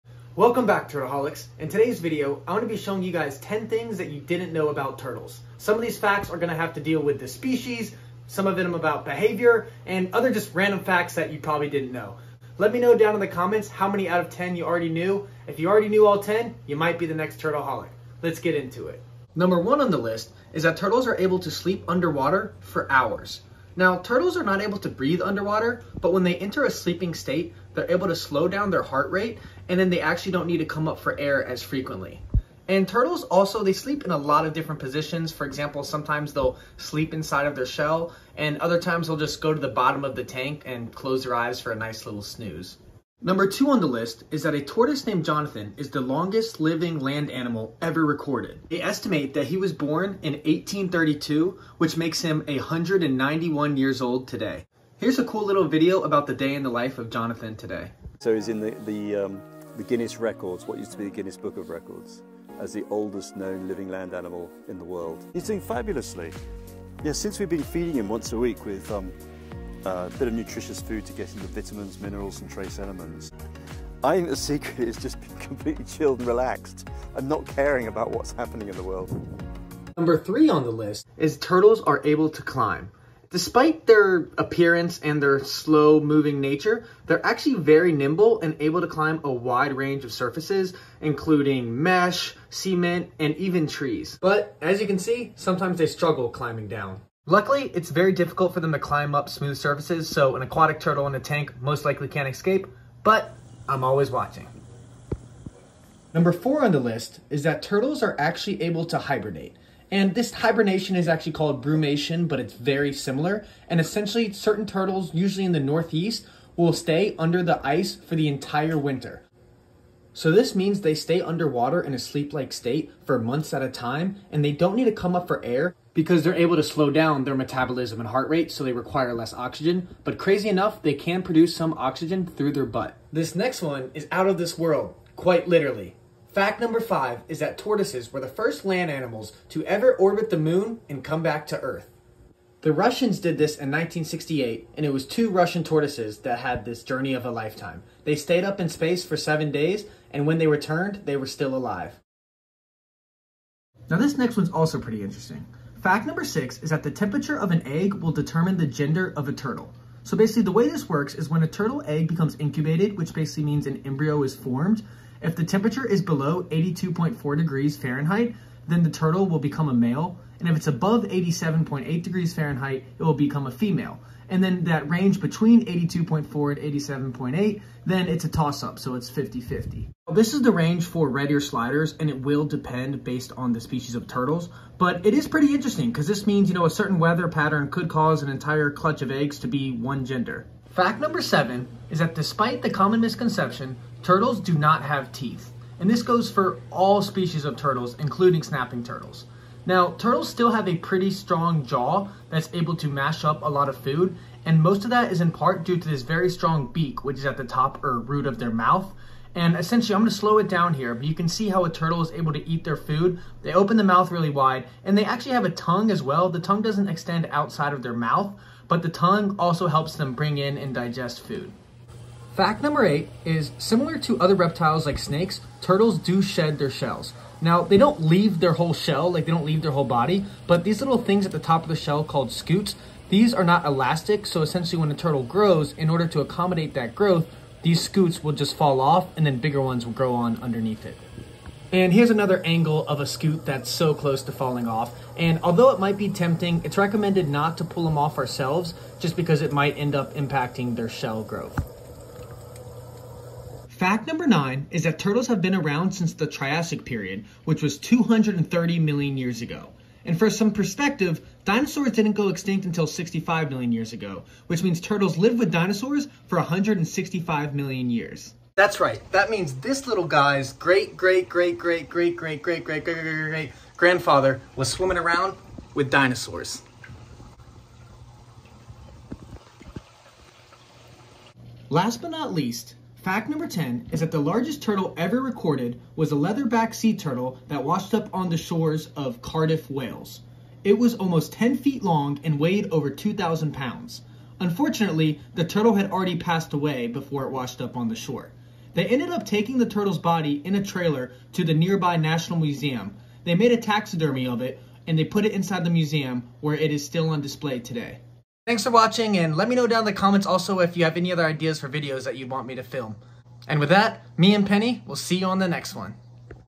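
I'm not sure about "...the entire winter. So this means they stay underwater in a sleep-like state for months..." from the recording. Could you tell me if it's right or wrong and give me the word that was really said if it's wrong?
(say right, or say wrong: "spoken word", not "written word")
right.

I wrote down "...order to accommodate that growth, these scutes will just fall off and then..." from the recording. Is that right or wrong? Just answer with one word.
right.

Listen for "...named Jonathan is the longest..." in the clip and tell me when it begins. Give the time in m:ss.
0:45.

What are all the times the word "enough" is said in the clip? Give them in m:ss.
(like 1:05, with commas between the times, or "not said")
2:10.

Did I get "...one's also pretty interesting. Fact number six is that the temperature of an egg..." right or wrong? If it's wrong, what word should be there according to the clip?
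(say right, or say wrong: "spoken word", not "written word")
right.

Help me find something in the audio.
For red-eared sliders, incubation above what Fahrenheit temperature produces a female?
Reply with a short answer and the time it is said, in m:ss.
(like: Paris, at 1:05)
87.8 degrees Fahrenheit, at 2:51.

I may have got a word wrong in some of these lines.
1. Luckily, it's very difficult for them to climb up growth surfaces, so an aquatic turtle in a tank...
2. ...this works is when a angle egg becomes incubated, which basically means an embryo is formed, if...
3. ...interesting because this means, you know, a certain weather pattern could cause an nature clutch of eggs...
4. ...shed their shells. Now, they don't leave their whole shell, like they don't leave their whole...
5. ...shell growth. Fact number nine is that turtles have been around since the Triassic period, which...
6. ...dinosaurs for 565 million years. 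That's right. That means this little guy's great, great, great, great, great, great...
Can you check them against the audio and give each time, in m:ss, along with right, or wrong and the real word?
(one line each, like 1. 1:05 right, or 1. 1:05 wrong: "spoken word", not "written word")
1. 1:37 wrong: "smooth", not "growth"
2. 2:40 wrong: "turtle", not "angle"
3. 3:05 wrong: "entire", not "nature"
4. 3:46 right
5. 4:10 right
6. 4:25 wrong: "165", not "565".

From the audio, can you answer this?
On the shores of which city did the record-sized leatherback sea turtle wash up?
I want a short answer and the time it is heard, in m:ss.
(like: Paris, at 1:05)
Cardiff, Wales, at 4:49.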